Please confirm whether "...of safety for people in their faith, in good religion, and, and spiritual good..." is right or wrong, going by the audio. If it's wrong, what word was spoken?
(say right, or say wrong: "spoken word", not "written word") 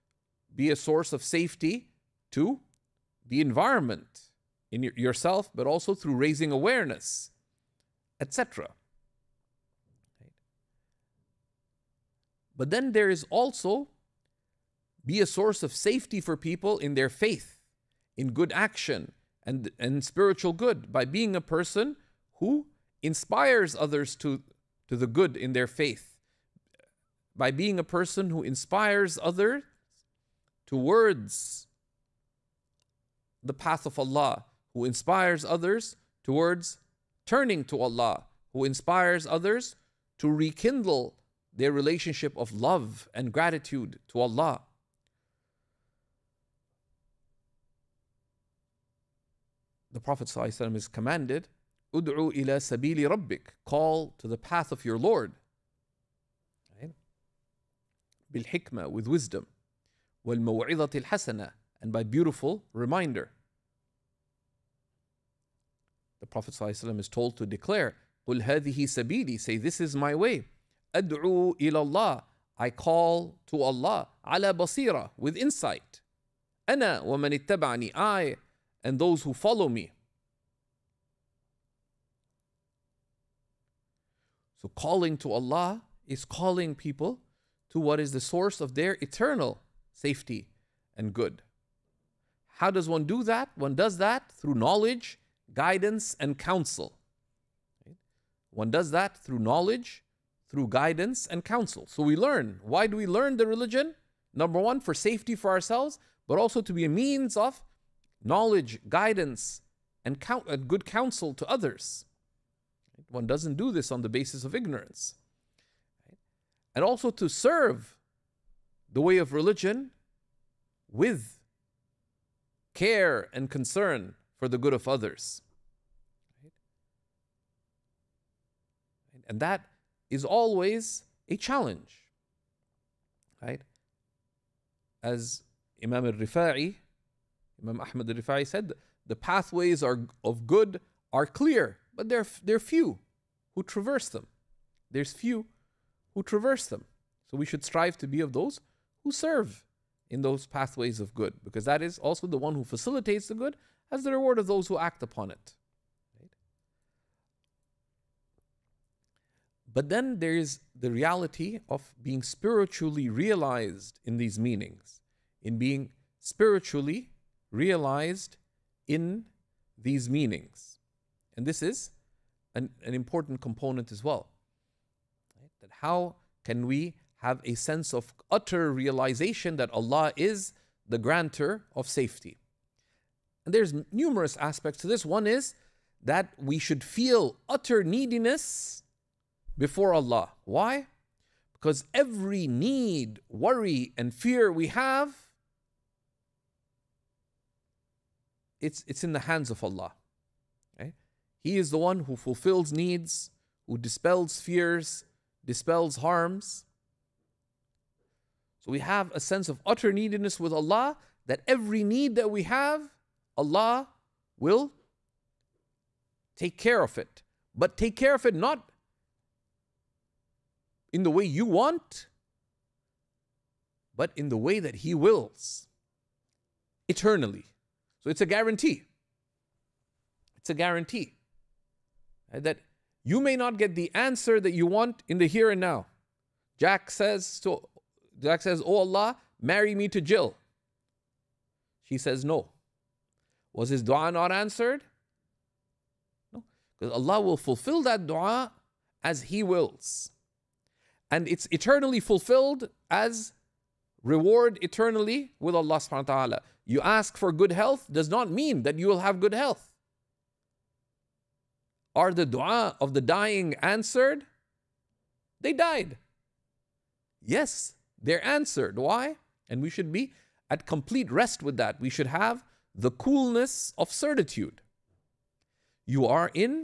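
wrong: "action", not "religion".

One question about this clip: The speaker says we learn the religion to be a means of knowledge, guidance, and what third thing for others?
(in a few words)
good counsel.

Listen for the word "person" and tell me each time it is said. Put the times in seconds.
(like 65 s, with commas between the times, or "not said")
21 s, 27 s.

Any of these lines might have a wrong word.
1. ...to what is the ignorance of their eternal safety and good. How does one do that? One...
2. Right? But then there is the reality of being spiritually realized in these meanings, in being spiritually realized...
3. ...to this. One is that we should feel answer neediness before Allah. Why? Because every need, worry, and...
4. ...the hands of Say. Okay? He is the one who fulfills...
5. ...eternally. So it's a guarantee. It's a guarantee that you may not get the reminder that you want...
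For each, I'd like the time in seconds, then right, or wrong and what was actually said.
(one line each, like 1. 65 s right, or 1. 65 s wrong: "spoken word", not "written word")
1. 87 s wrong: "source", not "ignorance"
2. 156 s right
3. 184 s wrong: "utter", not "answer"
4. 199 s wrong: "Allah", not "Say"
5. 226 s wrong: "answer", not "reminder".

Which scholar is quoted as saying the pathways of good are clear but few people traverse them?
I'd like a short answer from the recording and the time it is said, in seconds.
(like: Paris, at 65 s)
Imam Ahmad al-Rifa'i, at 137 s.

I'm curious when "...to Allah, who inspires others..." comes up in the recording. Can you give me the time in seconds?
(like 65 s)
37 s.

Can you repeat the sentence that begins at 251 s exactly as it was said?
And it's eternally fulfilled as reward eternally with Allah subhanahu wa ta'ala.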